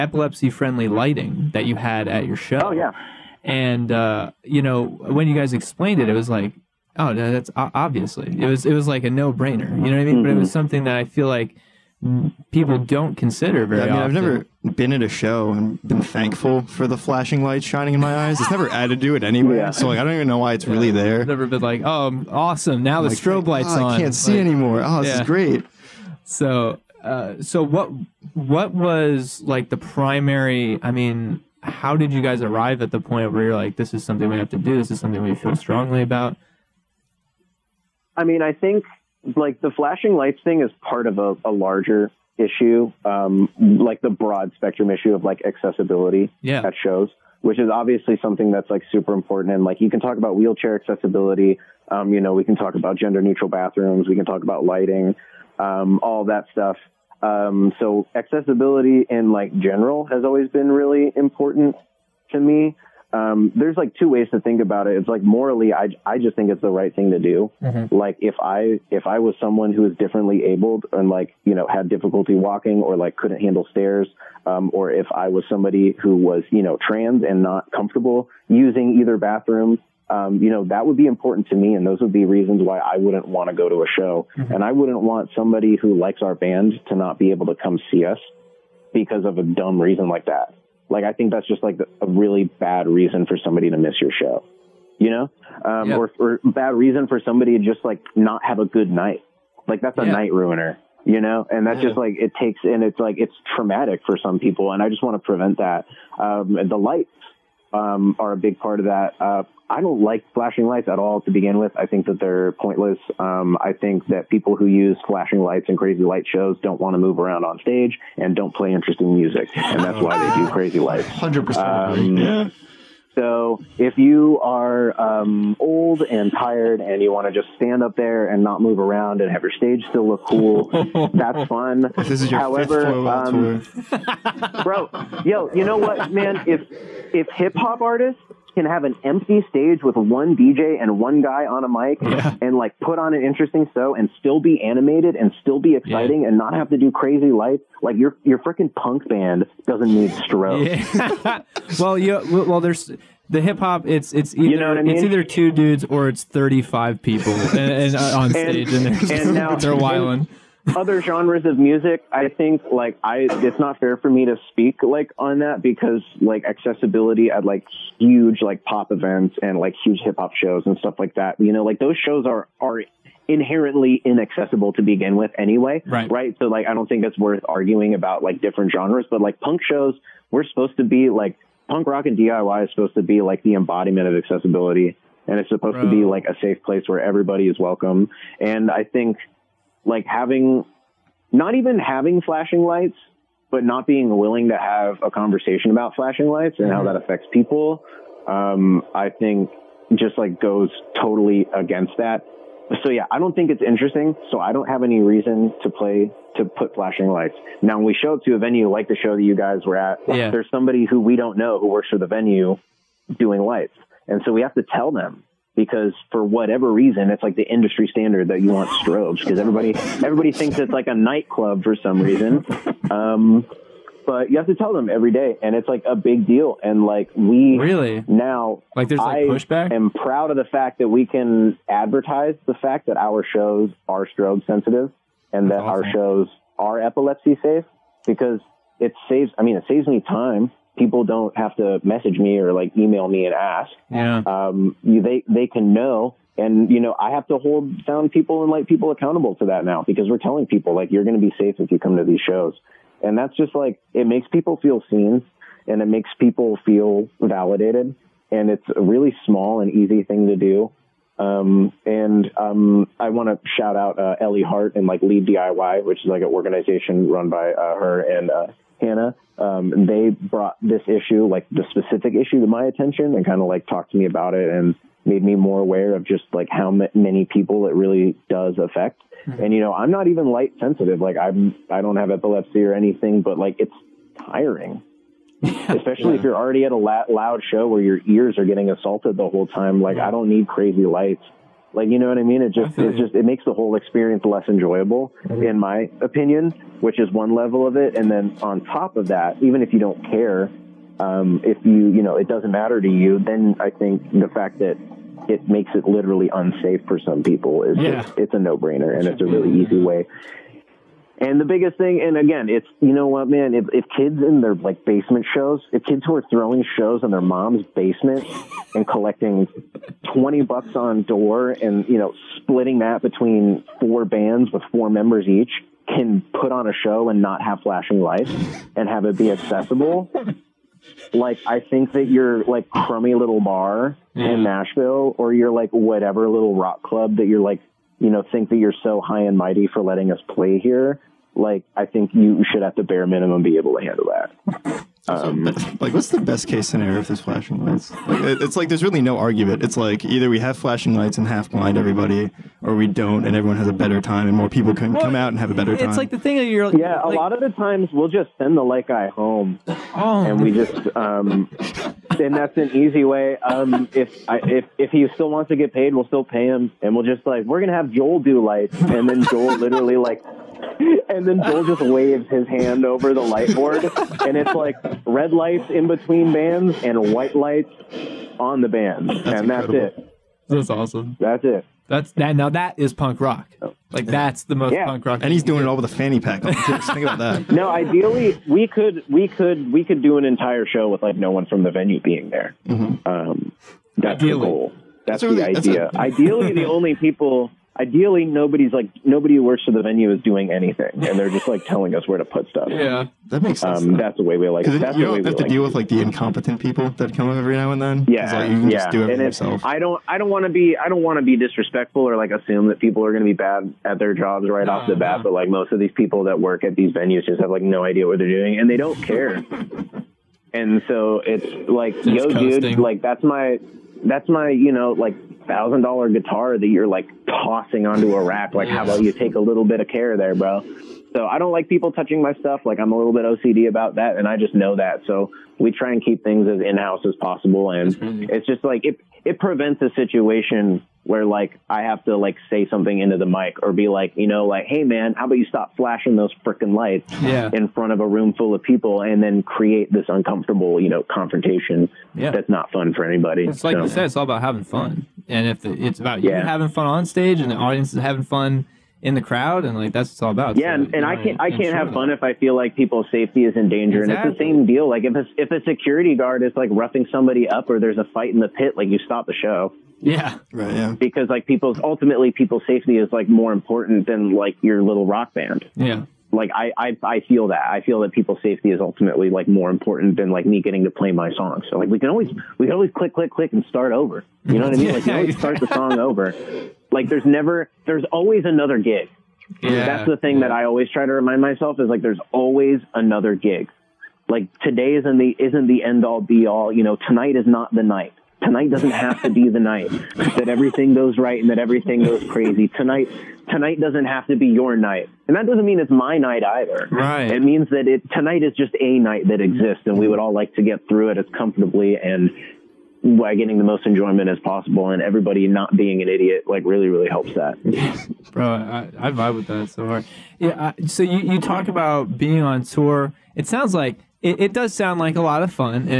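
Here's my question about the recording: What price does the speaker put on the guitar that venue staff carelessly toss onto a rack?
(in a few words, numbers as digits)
$1000.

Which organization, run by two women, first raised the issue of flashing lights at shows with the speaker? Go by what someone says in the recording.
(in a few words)
Lead DIY.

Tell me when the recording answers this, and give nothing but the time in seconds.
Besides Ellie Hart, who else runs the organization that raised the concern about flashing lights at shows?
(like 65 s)
268 s.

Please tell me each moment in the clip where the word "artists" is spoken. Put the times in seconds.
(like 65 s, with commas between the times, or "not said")
137 s.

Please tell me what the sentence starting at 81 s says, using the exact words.
And those would be reasons why I wouldn't want to go to a show.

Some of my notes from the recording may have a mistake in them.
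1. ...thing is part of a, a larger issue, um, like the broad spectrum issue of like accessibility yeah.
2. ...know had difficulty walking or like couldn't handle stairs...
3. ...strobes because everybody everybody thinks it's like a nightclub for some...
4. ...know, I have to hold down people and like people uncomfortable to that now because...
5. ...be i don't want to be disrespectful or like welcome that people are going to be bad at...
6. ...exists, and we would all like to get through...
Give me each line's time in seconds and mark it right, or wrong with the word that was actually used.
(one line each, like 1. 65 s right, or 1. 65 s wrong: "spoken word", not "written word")
1. 40 s right
2. 71 s right
3. 218 s right
4. 246 s wrong: "accountable", not "uncomfortable"
5. 410 s wrong: "assume", not "welcome"
6. 509 s right.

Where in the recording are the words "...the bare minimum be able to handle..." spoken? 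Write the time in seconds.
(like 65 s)
342 s.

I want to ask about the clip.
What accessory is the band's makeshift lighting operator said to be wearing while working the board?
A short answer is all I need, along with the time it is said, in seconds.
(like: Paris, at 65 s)
fanny pack, at 385 s.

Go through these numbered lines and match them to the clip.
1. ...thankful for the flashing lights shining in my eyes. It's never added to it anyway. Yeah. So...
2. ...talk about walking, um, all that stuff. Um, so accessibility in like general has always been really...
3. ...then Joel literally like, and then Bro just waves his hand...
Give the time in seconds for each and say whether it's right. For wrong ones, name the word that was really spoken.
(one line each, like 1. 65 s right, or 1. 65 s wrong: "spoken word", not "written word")
1. 16 s right
2. 54 s wrong: "lighting", not "walking"
3. 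369 s wrong: "Joel", not "Bro".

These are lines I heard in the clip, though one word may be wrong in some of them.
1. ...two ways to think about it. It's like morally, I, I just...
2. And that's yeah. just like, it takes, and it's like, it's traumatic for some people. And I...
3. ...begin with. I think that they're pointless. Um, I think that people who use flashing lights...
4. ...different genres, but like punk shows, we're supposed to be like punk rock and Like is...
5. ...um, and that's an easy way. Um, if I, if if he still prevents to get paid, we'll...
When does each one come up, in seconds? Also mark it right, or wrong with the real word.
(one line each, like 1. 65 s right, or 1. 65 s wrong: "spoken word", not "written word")
1. 63 s right
2. 101 s right
3. 111 s right
4. 178 s wrong: "DIY", not "Like"
5. 360 s wrong: "wants", not "prevents".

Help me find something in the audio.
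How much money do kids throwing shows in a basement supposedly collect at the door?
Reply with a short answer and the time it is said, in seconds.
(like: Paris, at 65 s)
$20, at 320 s.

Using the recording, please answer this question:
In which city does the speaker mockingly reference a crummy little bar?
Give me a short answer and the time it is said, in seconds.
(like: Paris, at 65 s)
Nashville, at 334 s.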